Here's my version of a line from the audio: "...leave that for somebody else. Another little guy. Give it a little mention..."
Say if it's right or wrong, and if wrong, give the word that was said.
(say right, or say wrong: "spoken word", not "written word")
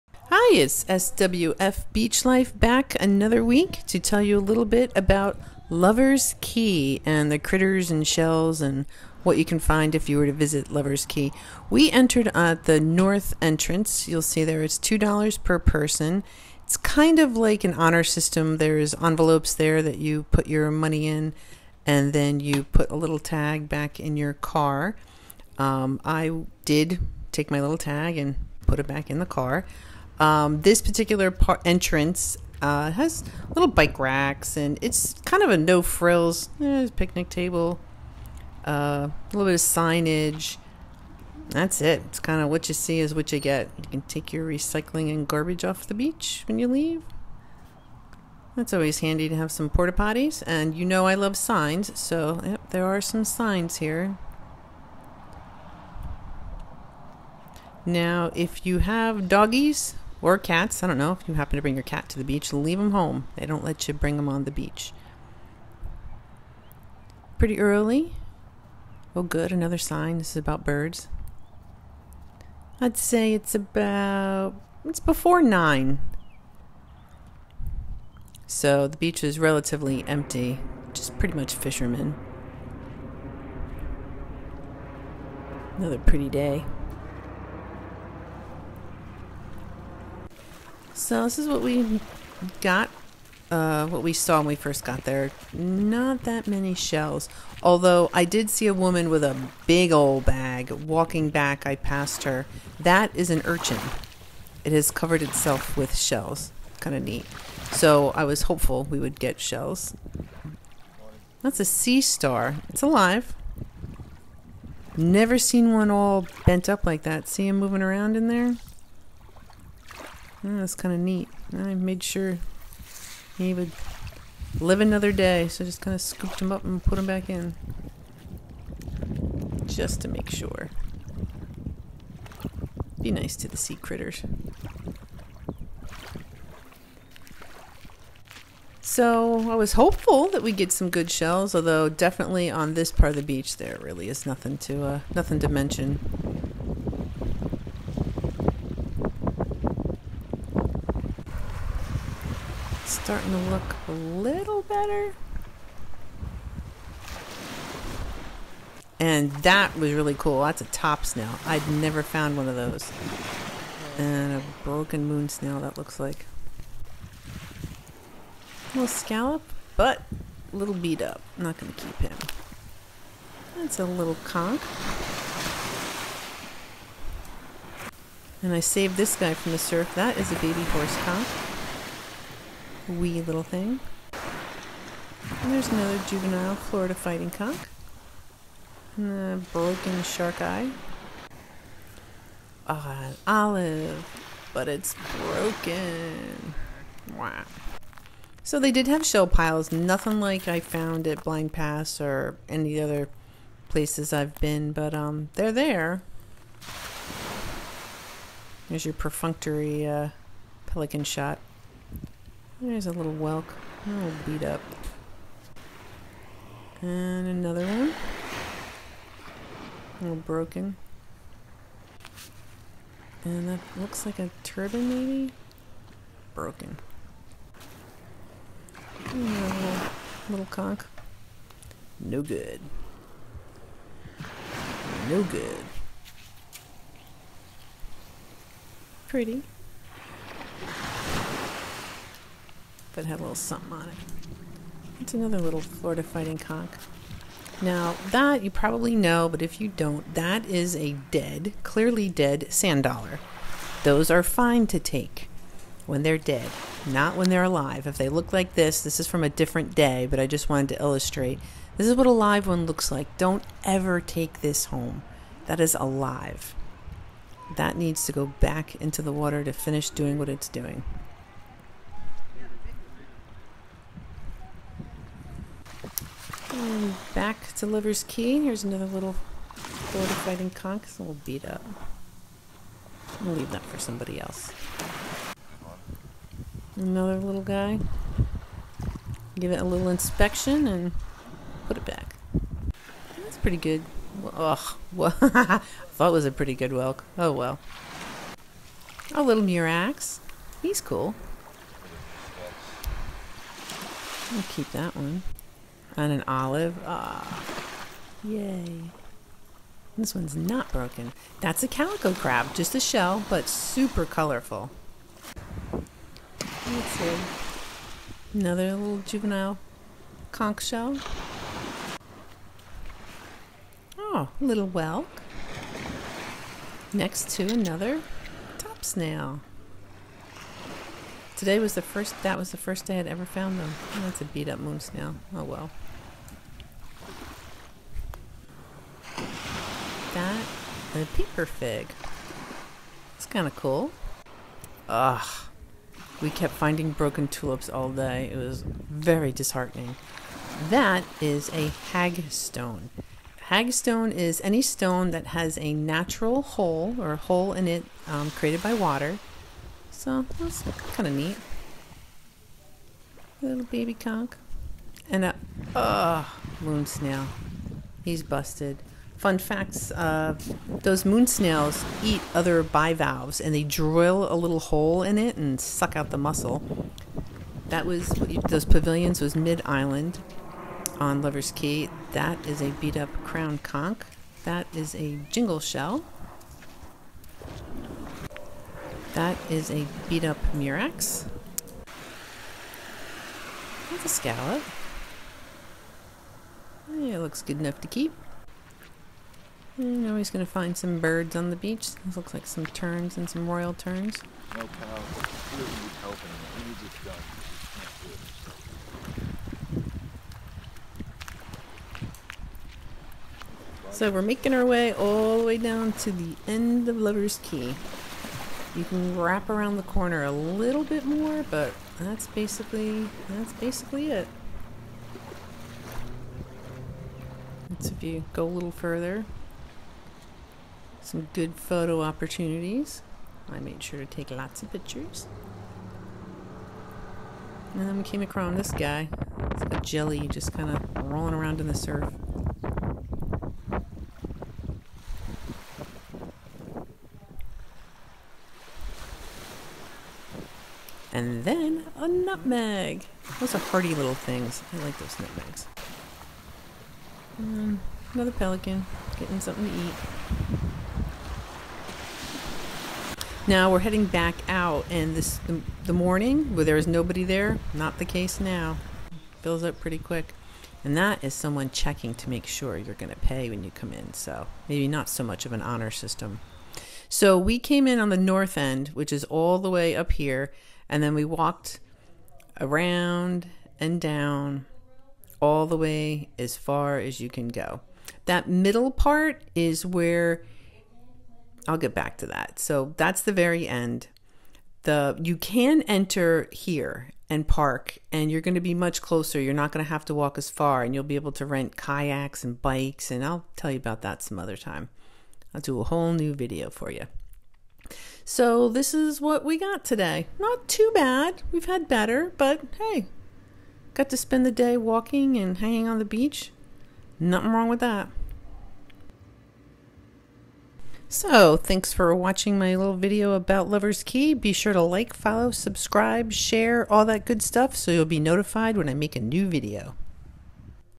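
wrong: "inspection", not "mention".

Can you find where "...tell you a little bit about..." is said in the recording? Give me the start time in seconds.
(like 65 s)
3 s.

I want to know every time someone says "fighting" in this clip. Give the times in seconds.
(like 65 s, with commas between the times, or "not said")
186 s, 246 s, 280 s.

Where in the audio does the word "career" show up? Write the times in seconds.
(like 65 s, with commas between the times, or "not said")
not said.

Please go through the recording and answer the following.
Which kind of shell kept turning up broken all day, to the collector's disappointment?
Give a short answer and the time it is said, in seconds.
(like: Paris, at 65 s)
tulips, at 347 s.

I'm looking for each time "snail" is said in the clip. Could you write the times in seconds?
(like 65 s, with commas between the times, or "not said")
161 s, 165 s, 328 s, 334 s, 366 s, 371 s.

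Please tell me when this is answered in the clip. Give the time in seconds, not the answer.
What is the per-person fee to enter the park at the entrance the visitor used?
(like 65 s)
14 s.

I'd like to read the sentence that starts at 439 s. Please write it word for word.
It's like a jelly just kind of rolling around in the surf.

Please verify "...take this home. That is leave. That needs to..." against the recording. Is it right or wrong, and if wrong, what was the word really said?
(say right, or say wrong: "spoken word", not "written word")
wrong: "alive", not "leave".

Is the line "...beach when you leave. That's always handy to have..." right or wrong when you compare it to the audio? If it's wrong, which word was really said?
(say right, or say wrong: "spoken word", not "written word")
right.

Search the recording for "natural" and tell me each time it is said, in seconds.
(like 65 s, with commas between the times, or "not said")
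355 s.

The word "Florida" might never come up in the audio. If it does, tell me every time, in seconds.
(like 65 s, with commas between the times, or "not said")
186 s, 245 s, 279 s.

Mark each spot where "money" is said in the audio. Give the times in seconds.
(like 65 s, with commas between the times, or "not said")
20 s.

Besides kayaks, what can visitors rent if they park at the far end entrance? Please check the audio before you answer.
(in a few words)
bikes.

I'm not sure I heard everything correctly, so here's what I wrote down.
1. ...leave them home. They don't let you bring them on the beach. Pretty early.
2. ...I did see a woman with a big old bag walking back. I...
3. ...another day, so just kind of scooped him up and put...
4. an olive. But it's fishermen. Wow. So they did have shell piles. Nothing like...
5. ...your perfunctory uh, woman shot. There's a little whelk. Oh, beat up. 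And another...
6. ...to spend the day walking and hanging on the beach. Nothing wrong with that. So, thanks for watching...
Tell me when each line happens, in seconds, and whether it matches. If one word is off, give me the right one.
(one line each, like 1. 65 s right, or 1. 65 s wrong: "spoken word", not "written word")
1. 62 s right
2. 98 s right
3. 124 s right
4. 192 s wrong: "broken", not "fishermen"
5. 208 s wrong: "pelican", not "woman"
6. 514 s right.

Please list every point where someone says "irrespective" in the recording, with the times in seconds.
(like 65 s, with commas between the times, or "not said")
not said.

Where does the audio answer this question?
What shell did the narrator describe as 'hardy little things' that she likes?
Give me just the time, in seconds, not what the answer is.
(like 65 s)
455 s.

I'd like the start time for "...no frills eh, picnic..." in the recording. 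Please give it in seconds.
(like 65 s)
35 s.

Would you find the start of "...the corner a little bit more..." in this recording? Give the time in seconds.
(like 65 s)
419 s.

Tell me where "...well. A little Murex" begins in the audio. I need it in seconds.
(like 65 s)
297 s.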